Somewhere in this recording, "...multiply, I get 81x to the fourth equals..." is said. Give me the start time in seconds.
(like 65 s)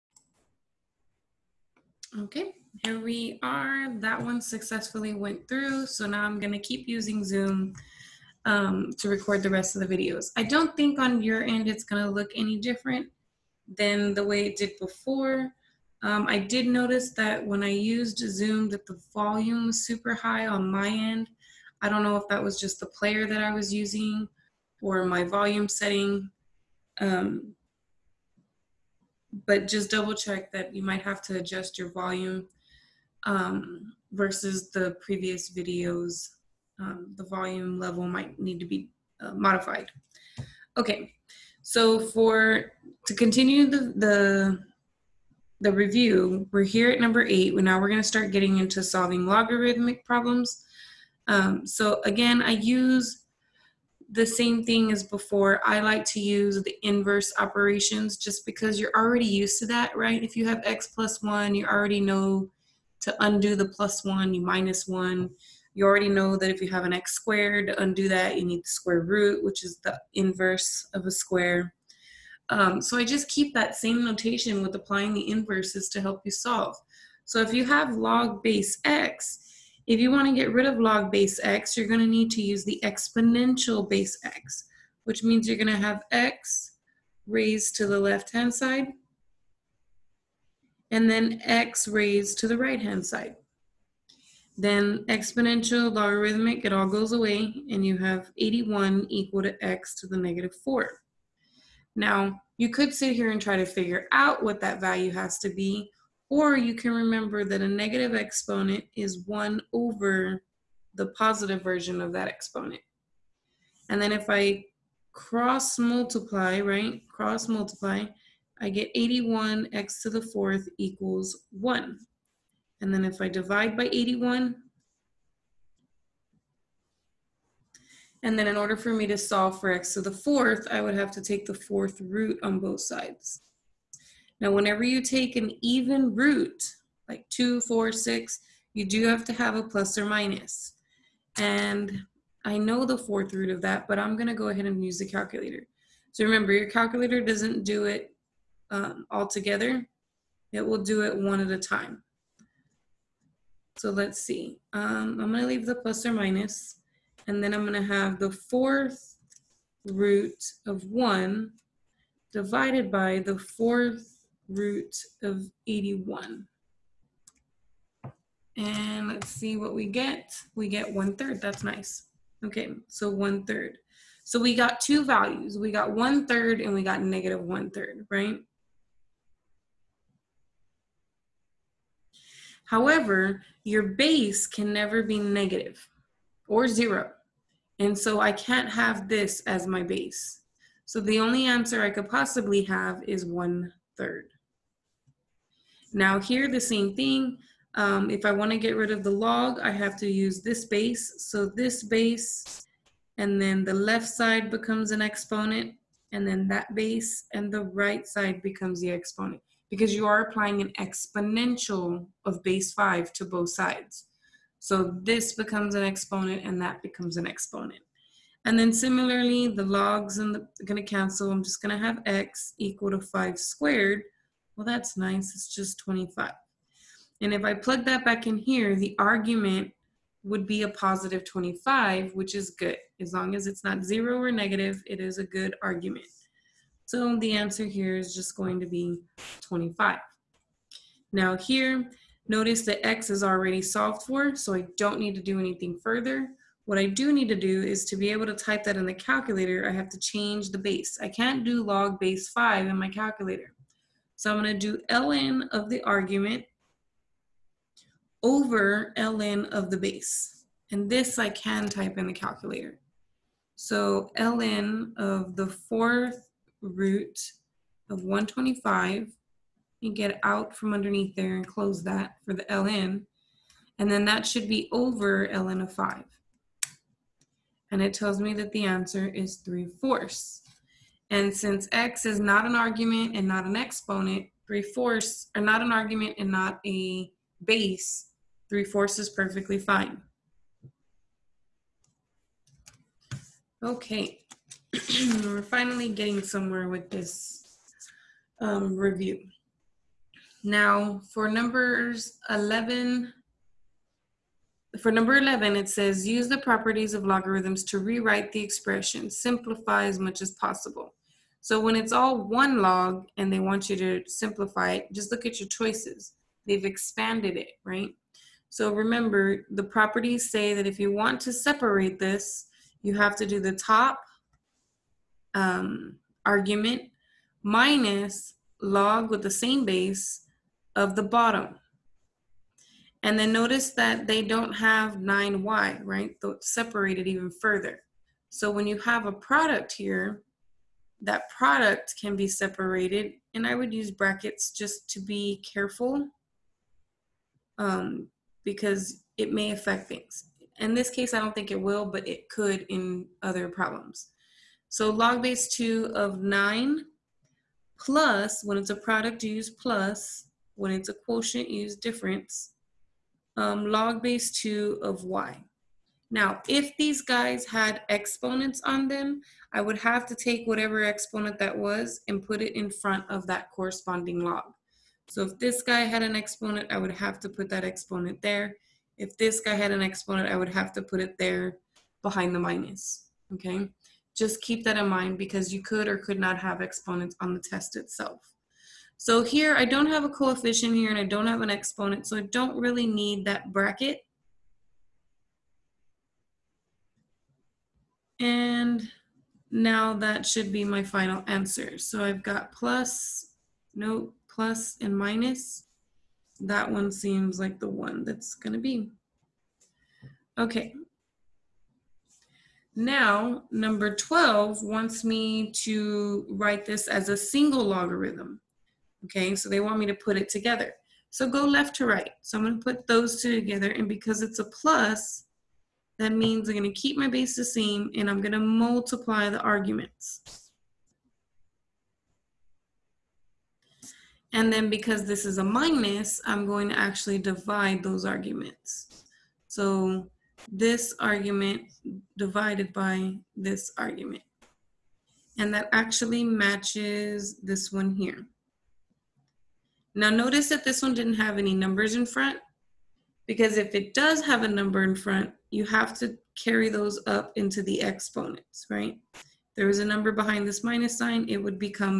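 117 s.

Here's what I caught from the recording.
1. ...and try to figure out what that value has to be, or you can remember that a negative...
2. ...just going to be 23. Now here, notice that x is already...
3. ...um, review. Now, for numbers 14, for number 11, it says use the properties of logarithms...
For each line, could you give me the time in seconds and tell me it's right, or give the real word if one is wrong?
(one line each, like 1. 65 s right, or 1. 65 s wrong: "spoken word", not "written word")
1. 103 s right
2. 238 s wrong: "25", not "23"
3. 298 s wrong: "11", not "14".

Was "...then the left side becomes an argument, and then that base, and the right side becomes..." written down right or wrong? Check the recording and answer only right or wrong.
wrong.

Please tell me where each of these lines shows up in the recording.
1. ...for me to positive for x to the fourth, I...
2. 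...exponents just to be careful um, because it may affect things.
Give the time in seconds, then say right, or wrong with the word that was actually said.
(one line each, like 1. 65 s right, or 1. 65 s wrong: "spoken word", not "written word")
1. 128 s wrong: "solve", not "positive"
2. 343 s wrong: "brackets", not "exponents".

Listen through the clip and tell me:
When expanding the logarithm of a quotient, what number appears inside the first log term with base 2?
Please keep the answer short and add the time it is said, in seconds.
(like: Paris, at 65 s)
9, at 356 s.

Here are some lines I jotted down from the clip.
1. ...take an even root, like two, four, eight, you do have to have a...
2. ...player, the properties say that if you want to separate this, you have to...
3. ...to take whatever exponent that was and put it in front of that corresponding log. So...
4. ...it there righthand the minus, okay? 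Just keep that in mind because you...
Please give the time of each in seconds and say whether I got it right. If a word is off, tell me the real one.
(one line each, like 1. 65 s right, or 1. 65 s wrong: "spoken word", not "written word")
1. 134 s wrong: "six", not "eight"
2. 318 s wrong: "remember", not "player"
3. 370 s right
4. 380 s wrong: "behind", not "righthand".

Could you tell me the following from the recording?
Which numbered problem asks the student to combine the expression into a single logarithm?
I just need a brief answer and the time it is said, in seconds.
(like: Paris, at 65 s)
12, at 413 s.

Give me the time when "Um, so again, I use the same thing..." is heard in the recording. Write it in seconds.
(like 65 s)
51 s.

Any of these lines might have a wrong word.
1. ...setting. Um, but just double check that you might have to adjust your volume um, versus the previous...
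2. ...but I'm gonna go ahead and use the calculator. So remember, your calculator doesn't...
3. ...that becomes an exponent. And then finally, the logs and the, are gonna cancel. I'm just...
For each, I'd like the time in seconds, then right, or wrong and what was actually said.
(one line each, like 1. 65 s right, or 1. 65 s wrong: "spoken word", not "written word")
1. 25 s right
2. 143 s right
3. 216 s wrong: "similarly", not "finally".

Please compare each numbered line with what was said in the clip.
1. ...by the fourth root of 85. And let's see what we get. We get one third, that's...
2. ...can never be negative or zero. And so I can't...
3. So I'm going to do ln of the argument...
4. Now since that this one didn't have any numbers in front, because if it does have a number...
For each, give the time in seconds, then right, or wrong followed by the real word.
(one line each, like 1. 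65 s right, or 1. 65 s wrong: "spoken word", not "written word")
1. 162 s wrong: "81", not "85"
2. 184 s right
3. 254 s right
4. 449 s wrong: "notice", not "since".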